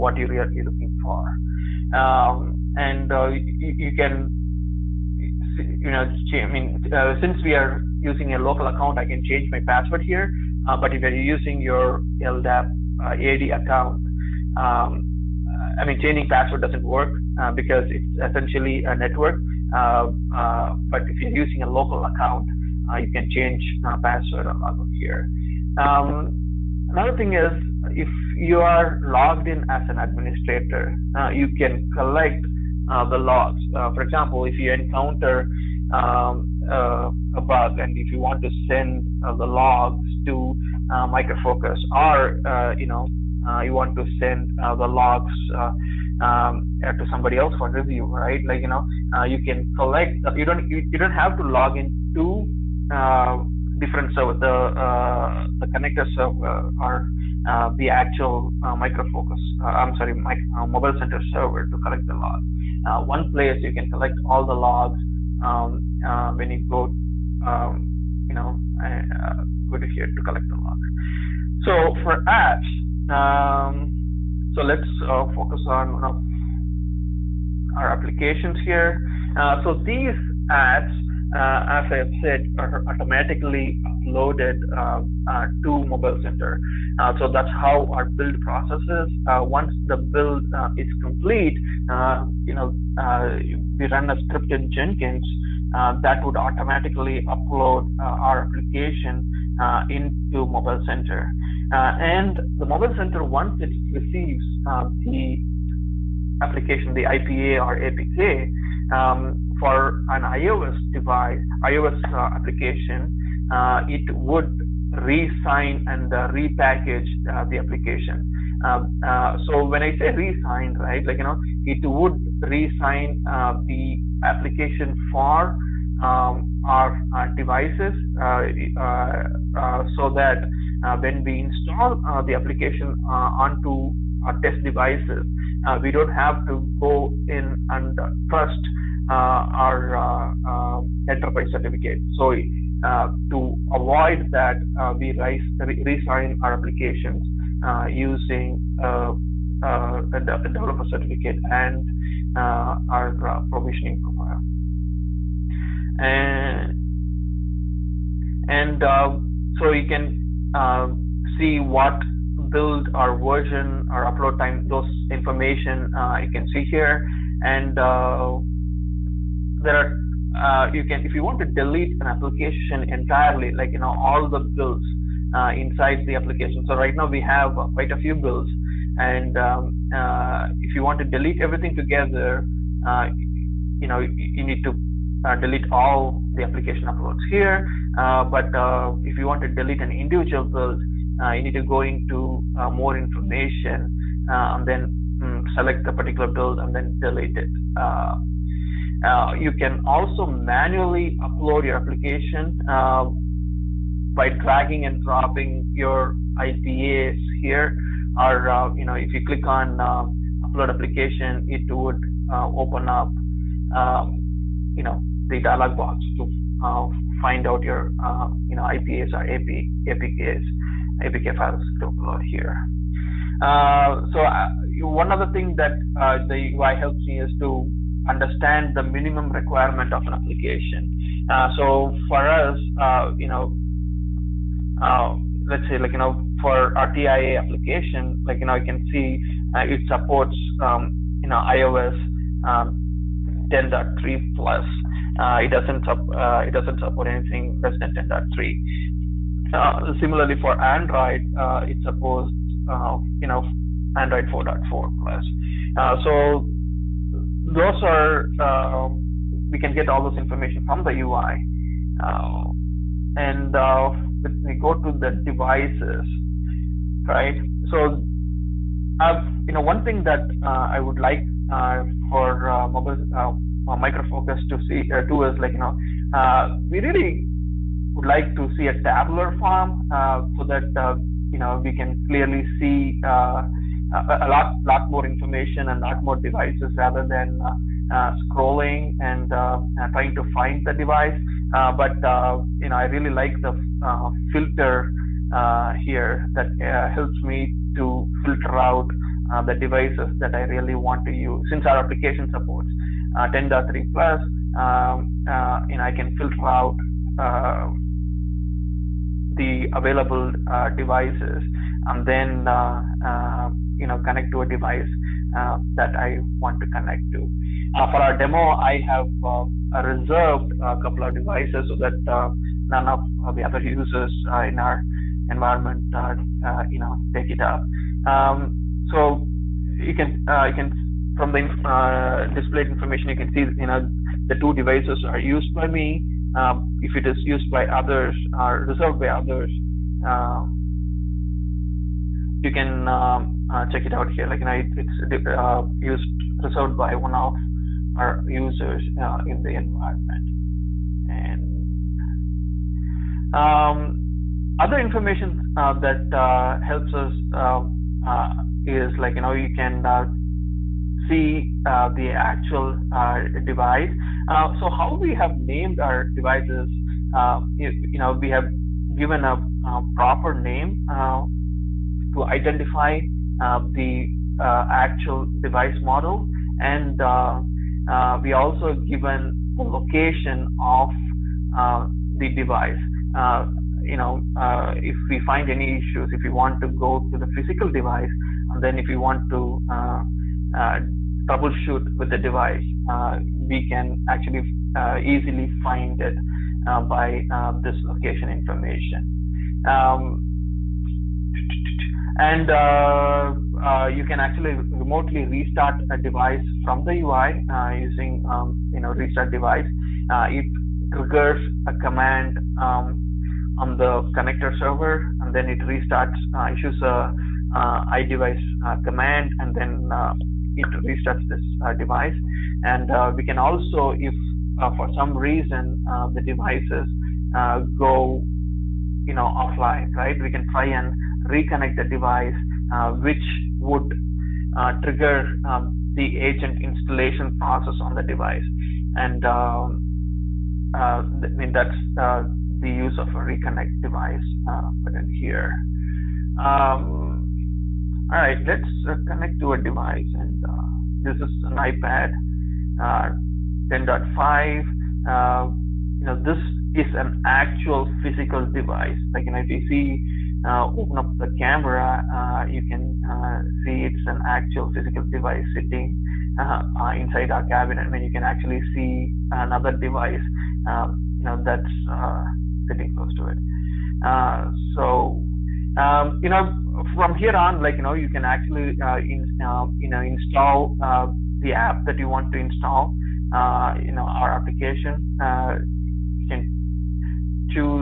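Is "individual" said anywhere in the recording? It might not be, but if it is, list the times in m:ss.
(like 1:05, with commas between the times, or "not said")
3:09.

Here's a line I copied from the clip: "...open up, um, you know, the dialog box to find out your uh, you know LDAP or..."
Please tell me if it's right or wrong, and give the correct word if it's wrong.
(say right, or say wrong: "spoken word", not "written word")
wrong: "IPAs", not "LDAP".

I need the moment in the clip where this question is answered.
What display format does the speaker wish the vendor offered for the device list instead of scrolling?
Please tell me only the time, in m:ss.
4:38.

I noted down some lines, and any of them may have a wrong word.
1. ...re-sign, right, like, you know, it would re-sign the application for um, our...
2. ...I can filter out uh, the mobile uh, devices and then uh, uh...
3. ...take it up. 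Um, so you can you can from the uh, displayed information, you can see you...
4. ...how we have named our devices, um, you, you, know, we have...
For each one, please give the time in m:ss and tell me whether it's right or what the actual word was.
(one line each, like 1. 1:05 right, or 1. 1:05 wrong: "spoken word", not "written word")
1. 2:00 right
2. 5:05 wrong: "available", not "mobile"
3. 5:27 right
4. 6:04 right.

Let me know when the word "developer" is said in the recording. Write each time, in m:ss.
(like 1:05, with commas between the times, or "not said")
2:30.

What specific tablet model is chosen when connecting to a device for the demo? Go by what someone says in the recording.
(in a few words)
iPad 10.5.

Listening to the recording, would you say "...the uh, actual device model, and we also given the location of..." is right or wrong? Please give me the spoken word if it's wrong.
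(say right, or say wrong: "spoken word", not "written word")
right.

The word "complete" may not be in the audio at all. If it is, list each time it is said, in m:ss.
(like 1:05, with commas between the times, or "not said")
1:30.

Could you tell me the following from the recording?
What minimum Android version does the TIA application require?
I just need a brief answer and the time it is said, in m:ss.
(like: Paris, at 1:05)
4.4, at 4:13.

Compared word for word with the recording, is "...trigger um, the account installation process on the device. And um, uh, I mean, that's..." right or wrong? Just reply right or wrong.
wrong.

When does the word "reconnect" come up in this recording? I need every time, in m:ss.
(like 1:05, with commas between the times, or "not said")
7:11, 7:23.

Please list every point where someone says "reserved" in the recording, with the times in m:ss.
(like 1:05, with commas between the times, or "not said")
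5:19, 5:38, 5:46.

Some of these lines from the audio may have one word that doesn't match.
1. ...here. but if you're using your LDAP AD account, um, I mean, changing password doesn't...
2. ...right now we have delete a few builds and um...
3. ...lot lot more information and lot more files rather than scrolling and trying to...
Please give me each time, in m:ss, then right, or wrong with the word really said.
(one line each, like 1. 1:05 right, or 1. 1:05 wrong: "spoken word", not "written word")
1. 0:10 right
2. 2:56 wrong: "quite", not "delete"
3. 4:44 wrong: "devices", not "files".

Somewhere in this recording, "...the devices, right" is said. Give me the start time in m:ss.
4:24.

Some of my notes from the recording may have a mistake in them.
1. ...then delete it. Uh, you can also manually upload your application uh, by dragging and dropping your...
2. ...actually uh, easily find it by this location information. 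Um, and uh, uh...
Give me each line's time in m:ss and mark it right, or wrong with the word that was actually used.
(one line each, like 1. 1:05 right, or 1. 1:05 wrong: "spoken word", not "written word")
1. 3:16 right
2. 6:34 right.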